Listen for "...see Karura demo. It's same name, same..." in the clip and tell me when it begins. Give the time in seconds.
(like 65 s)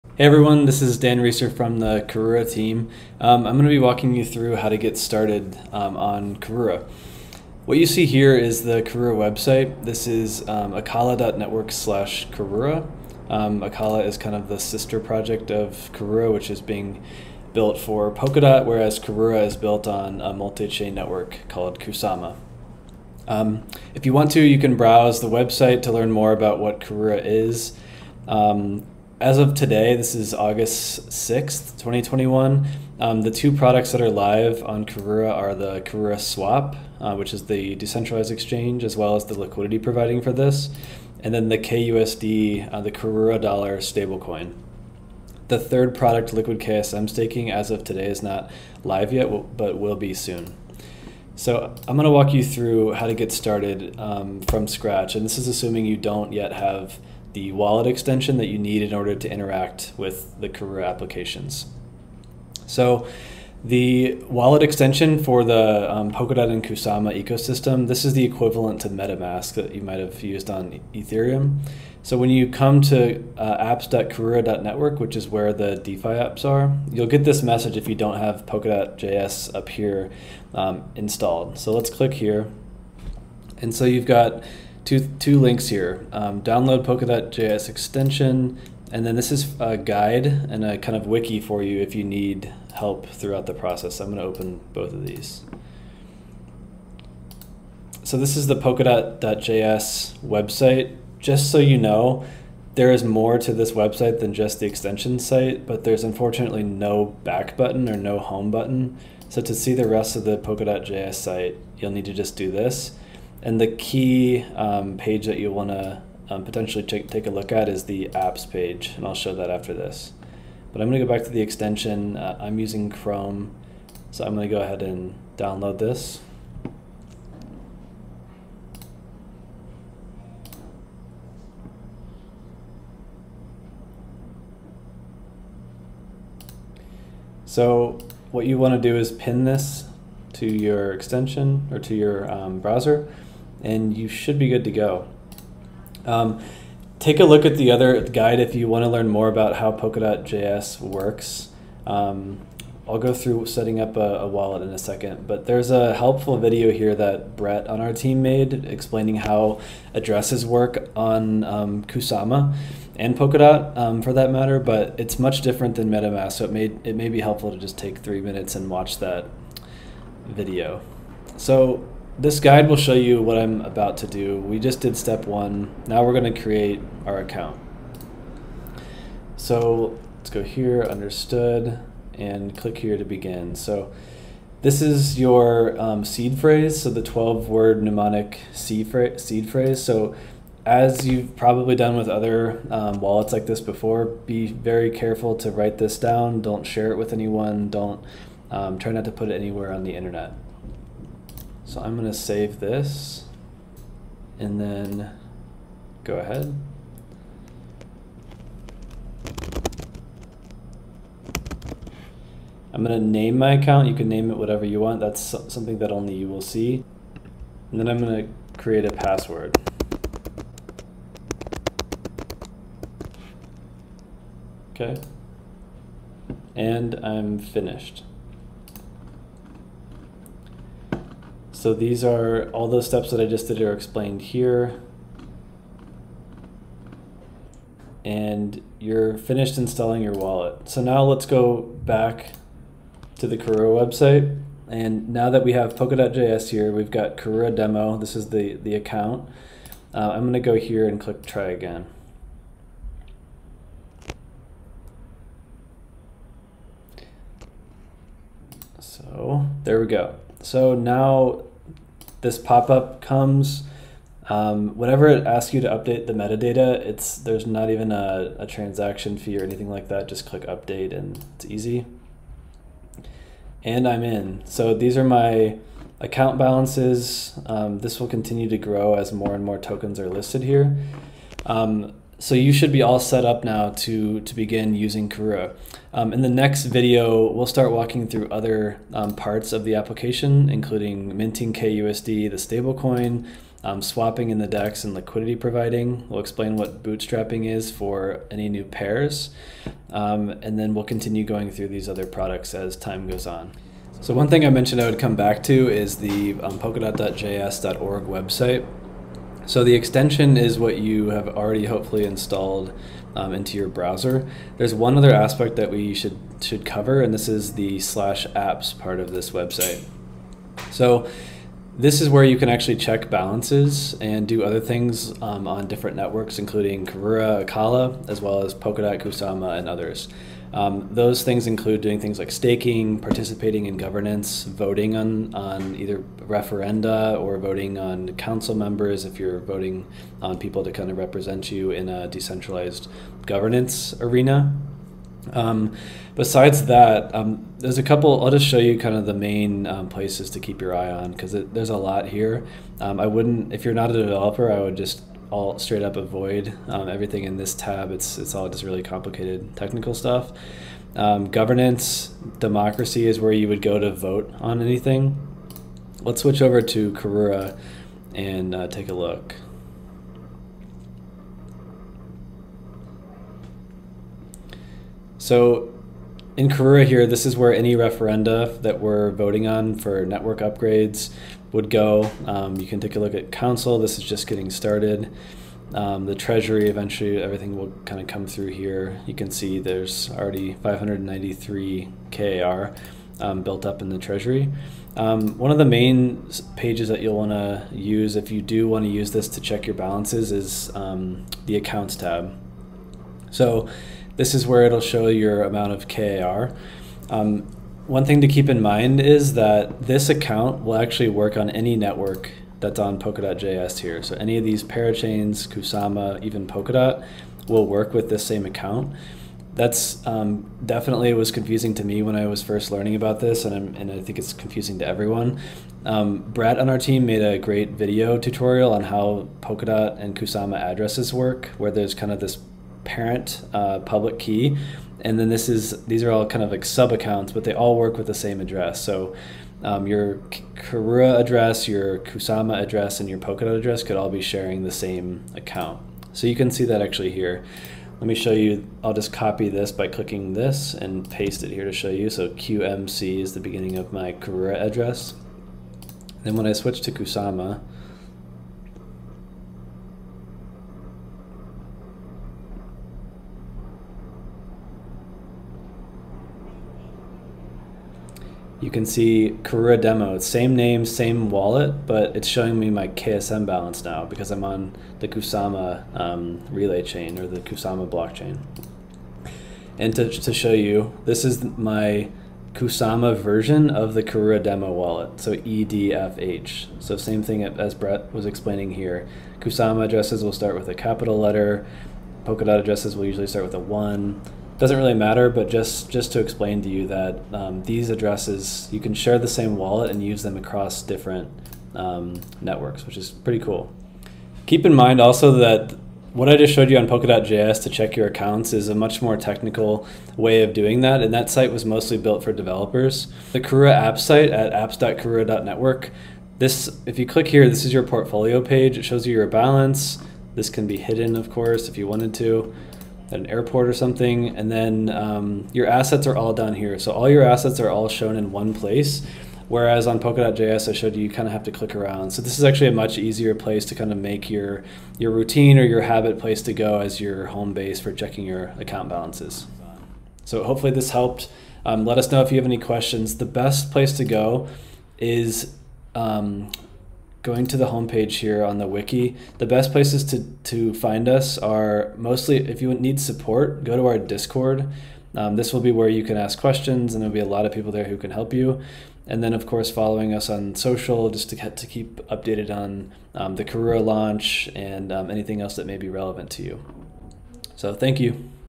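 468 s.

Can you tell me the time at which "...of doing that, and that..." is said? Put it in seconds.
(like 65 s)
510 s.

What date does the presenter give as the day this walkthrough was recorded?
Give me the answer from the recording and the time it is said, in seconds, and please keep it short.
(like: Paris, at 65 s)
August 6th, 2021, at 30 s.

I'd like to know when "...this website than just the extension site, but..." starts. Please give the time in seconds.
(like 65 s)
103 s.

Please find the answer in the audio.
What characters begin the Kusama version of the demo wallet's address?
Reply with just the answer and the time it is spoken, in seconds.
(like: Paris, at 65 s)
EDFH, at 485 s.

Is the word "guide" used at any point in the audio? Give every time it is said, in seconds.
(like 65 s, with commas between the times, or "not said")
89 s, 148 s, 172 s.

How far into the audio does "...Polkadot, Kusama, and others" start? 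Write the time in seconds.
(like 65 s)
328 s.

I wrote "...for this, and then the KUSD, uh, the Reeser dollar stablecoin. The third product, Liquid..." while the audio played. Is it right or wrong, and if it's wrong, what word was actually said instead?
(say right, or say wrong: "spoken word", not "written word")
wrong: "Karura", not "Reeser".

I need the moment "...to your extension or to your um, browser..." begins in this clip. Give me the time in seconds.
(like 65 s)
140 s.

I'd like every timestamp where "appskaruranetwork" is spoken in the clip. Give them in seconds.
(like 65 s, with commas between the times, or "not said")
73 s, 514 s.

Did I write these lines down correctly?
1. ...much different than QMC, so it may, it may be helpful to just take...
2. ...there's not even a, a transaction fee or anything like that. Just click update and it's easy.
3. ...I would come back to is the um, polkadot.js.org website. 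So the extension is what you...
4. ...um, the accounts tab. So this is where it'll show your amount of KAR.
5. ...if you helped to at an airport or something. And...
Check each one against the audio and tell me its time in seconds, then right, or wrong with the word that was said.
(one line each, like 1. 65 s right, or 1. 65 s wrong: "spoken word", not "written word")
1. 165 s wrong: "MetaMask", not "QMC"
2. 267 s right
3. 304 s right
4. 400 s right
5. 521 s wrong: "wanted", not "helped".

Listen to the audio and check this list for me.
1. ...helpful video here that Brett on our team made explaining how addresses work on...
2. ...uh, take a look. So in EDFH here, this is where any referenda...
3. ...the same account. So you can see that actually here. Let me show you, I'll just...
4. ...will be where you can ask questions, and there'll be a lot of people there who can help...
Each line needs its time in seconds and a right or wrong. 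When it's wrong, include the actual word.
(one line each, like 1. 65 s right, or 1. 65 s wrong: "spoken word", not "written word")
1. 155 s right
2. 368 s wrong: "Karura", not "EDFH"
3. 444 s right
4. 555 s right.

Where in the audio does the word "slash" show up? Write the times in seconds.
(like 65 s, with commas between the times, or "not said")
11 s, 317 s.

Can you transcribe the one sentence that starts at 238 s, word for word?
And you're finished installing your wallet.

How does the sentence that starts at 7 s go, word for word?
What you see here is the Karura website.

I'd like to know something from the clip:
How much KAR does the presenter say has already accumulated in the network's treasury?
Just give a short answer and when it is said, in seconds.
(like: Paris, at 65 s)
593 KAR, at 390 s.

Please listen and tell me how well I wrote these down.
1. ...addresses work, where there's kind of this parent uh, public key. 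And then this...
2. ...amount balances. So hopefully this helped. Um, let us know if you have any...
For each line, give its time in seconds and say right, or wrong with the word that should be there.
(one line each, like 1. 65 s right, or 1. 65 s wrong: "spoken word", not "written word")
1. 430 s right
2. 538 s wrong: "account", not "amount".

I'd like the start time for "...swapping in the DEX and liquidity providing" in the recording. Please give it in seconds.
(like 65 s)
293 s.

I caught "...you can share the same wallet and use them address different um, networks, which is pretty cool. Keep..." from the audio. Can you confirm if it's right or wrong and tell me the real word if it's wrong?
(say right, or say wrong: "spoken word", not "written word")
wrong: "across", not "address".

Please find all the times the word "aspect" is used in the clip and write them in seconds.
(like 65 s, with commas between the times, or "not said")
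315 s.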